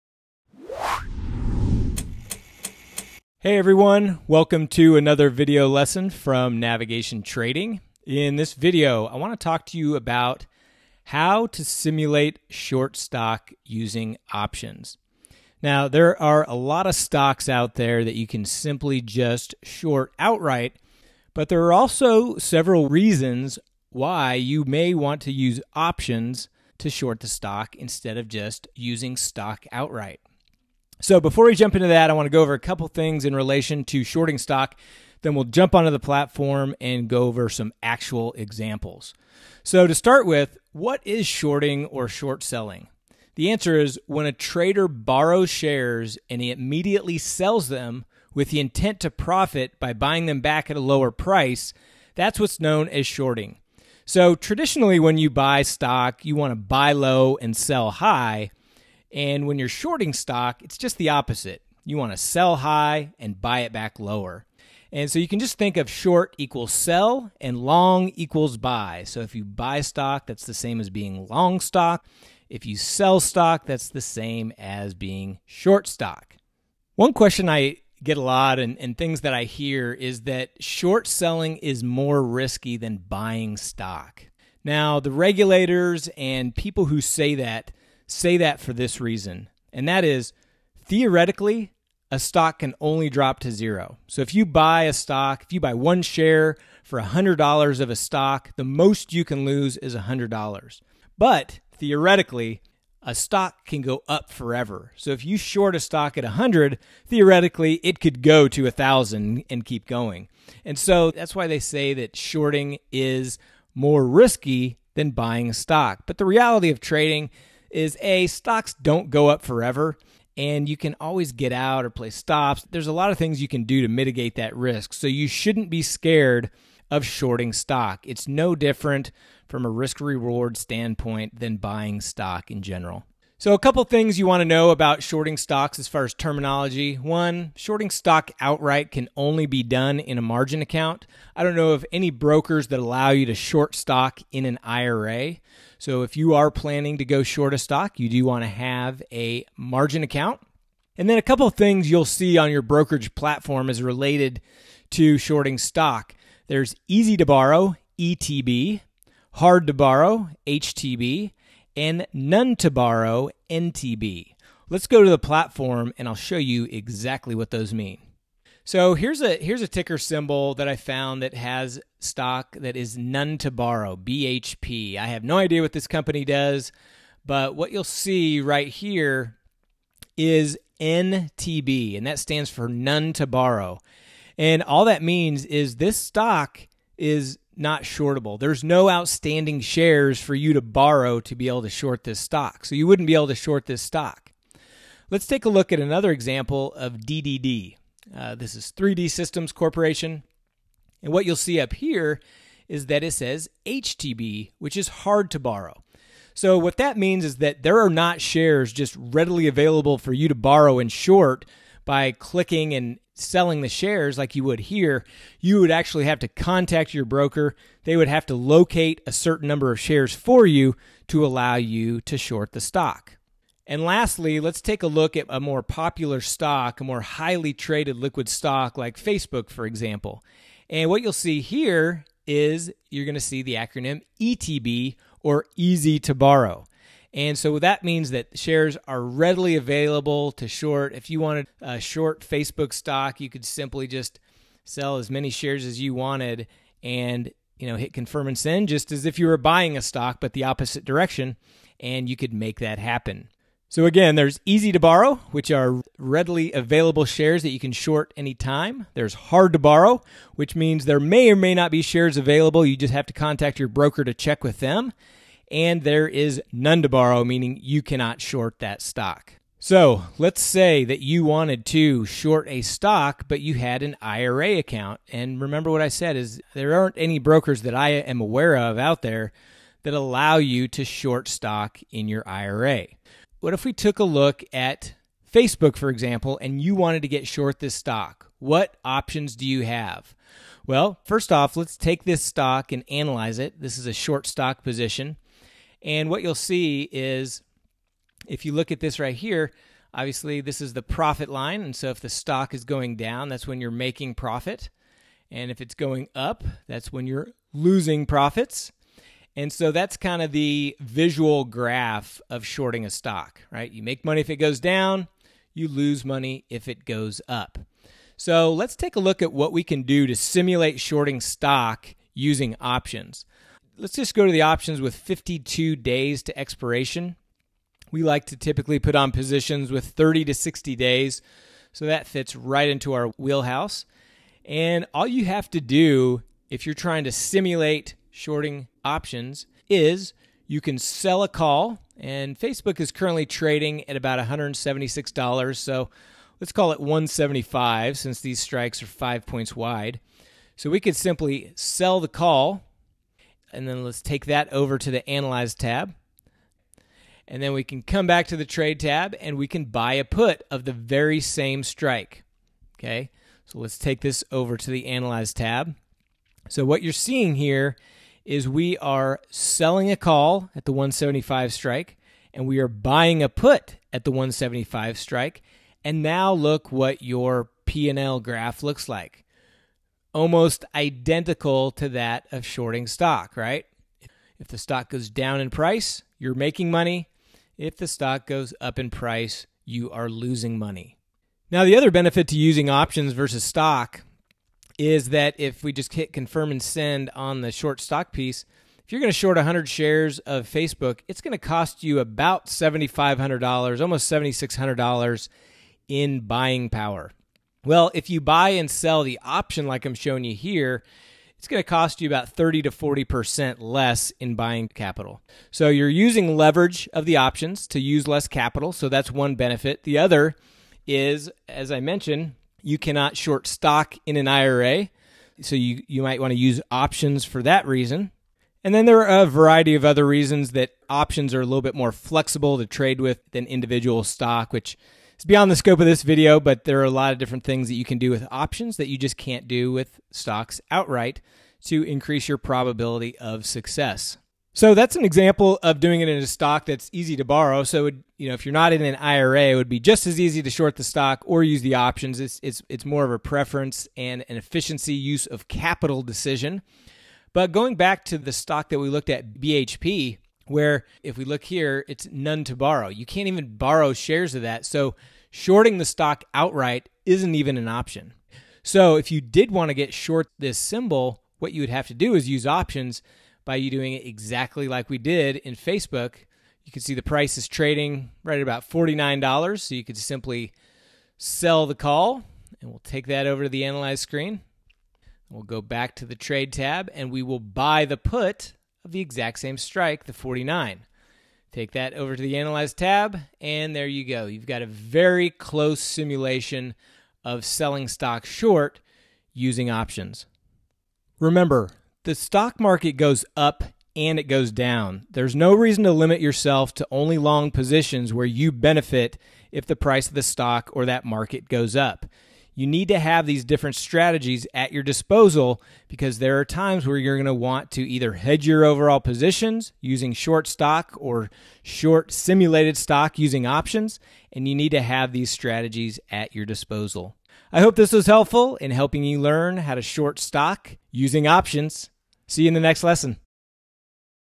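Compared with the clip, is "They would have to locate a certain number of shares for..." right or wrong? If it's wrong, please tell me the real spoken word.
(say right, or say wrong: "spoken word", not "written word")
right.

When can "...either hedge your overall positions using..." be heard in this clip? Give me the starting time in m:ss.
8:37.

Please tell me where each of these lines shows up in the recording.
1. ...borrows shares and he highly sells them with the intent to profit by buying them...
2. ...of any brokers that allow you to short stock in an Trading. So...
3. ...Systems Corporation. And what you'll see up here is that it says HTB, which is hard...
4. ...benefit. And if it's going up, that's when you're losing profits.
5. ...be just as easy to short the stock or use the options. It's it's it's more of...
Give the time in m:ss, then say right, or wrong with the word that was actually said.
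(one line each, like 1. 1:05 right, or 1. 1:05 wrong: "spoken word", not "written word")
1. 0:44 wrong: "immediately", not "highly"
2. 2:21 wrong: "IRA", not "Trading"
3. 3:19 right
4. 5:04 wrong: "profit", not "benefit"
5. 7:29 right.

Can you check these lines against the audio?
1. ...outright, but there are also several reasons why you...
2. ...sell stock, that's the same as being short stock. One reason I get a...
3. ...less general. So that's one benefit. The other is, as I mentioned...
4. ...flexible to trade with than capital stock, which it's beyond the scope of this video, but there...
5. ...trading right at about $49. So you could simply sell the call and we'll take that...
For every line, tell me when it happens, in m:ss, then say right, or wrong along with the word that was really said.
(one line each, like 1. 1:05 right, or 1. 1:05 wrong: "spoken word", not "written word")
1. 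0:20 right
2. 1:12 wrong: "question", not "reason"
3. 6:58 wrong: "capital", not "general"
4. 7:11 wrong: "individual", not "capital"
5. 7:57 right.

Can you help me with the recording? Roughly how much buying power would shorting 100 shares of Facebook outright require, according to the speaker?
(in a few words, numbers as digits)
About $7,500.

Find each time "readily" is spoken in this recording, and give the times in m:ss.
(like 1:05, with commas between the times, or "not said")
3:28, 3:59, 4:15.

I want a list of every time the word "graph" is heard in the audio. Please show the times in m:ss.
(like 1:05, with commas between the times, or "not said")
5:11, 6:18.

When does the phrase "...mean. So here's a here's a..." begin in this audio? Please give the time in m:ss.
2:47.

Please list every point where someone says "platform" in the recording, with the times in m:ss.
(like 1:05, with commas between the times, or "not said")
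0:35, 2:33, 2:45.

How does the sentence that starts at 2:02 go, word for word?
There's a lot of things you can do to mitigate that risk.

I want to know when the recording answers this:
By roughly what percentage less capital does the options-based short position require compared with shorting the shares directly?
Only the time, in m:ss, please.
6:52.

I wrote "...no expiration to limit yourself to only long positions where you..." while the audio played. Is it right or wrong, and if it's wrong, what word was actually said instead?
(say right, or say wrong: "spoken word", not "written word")
wrong: "reason", not "expiration".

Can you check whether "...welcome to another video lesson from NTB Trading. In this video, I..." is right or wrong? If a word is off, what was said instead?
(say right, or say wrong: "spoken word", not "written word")
wrong: "Navigation", not "NTB".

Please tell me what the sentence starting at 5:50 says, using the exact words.
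So we could simply sell the call and then let's take that over to the Analyze tab.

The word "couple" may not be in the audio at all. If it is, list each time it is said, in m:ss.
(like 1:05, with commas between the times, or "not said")
0:32, 2:13, 2:31.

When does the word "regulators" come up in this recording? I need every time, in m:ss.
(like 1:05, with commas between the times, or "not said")
1:25.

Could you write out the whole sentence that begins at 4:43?
What if we took a look at Facebook, for example, and you wanted to get short this stock?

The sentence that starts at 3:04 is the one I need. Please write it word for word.
And all that means is this stock is not shortable.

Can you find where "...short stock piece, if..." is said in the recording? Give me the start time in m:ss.
6:37.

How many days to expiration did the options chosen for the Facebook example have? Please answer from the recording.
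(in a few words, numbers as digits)
52.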